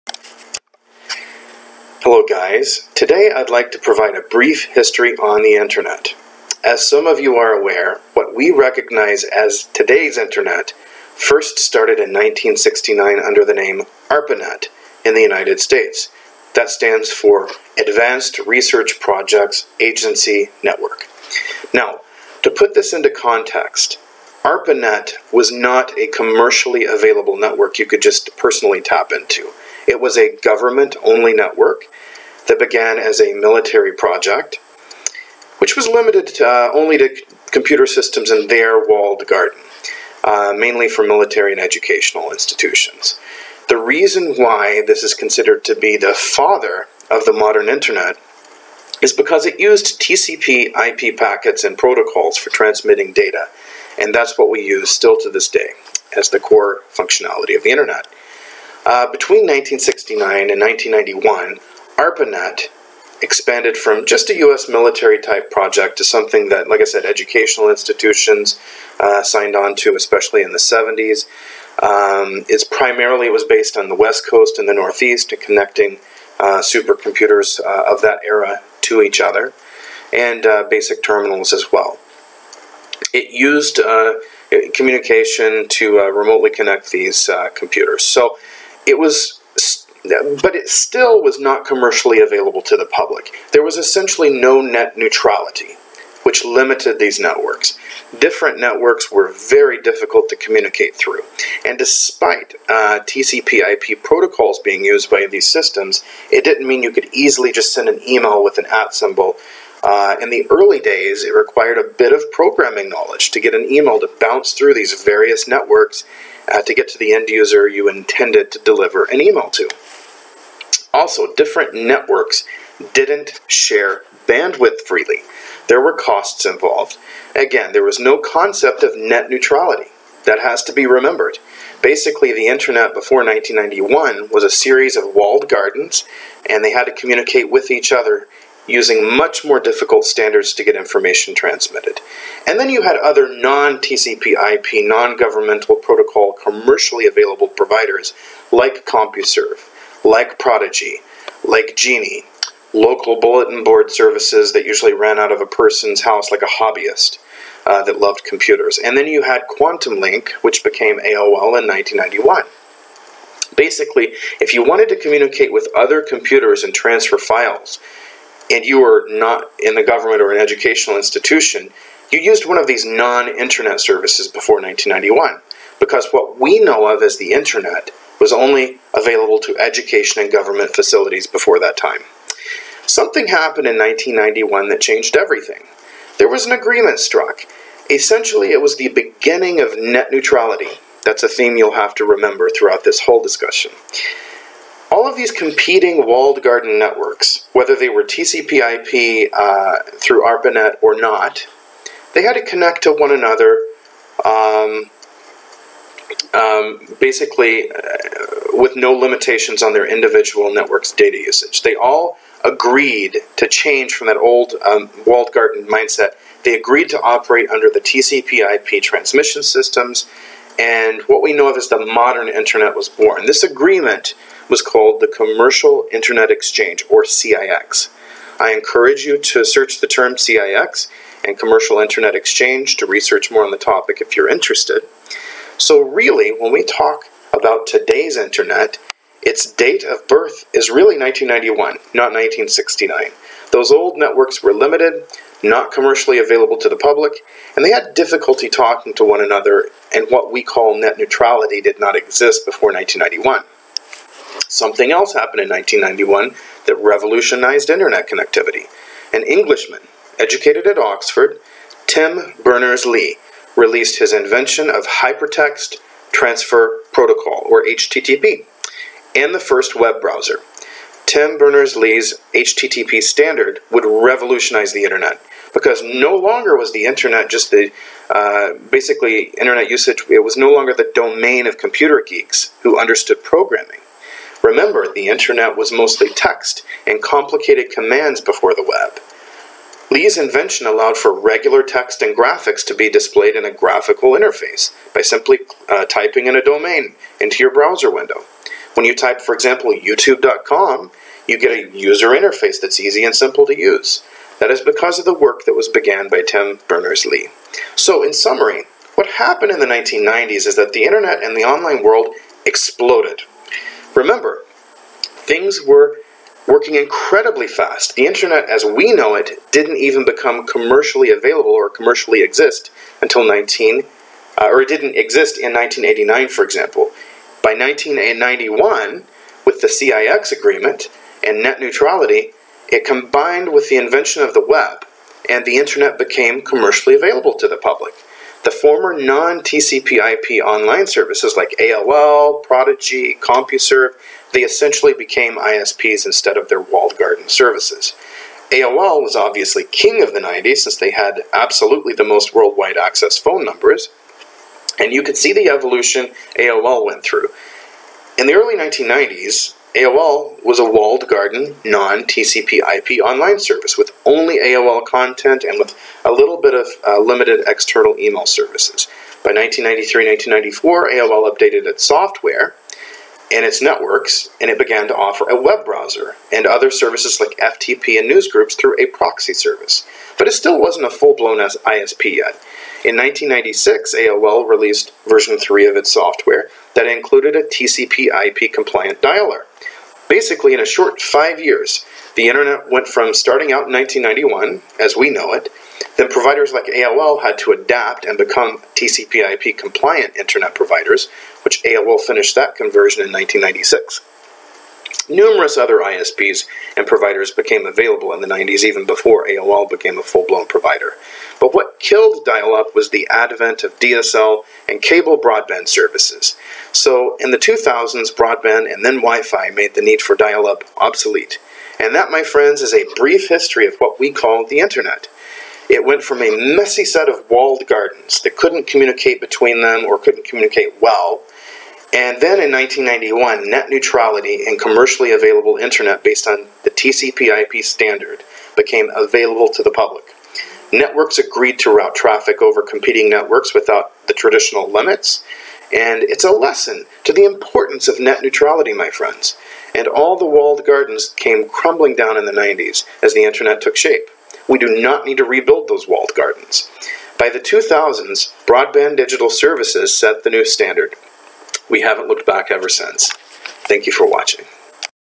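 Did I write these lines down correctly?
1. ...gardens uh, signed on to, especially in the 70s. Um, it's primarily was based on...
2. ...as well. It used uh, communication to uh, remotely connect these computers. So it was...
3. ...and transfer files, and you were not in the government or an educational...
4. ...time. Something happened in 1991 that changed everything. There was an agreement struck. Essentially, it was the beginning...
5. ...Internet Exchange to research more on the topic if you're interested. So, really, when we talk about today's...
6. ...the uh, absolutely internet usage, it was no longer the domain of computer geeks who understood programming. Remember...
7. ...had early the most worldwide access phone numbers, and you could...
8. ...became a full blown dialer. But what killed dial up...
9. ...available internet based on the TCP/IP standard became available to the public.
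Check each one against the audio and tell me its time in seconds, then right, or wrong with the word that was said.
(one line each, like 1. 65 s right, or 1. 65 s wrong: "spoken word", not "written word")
1. 67 s wrong: "institutions", not "gardens"
2. 81 s right
3. 166 s right
4. 181 s right
5. 231 s right
6. 277 s wrong: "basically", not "absolutely"
7. 350 s wrong: "absolutely", not "early"
8. 409 s wrong: "provider", not "dialer"
9. 435 s right.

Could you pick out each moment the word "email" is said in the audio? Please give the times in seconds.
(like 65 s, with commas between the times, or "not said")
108 s, 113 s, 119 s, 367 s.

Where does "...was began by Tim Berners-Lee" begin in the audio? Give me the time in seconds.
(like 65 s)
305 s.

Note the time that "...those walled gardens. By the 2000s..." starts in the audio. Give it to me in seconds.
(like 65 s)
455 s.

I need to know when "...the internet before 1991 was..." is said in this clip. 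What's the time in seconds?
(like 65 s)
132 s.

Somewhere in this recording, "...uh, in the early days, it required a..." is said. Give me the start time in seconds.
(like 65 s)
109 s.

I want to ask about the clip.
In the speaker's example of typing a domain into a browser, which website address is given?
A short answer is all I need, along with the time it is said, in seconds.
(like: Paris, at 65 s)
youtube.com, at 299 s.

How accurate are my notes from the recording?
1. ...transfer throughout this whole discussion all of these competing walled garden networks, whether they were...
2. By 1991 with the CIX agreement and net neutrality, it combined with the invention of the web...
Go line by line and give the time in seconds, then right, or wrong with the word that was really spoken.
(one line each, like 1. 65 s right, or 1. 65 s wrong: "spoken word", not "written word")
1. 192 s wrong: "remember", not "transfer"
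2. 327 s right.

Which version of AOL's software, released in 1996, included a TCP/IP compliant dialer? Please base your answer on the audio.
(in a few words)
Version 3.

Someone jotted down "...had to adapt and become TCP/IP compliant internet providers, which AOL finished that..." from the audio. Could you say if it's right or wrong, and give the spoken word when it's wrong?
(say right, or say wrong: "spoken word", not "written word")
right.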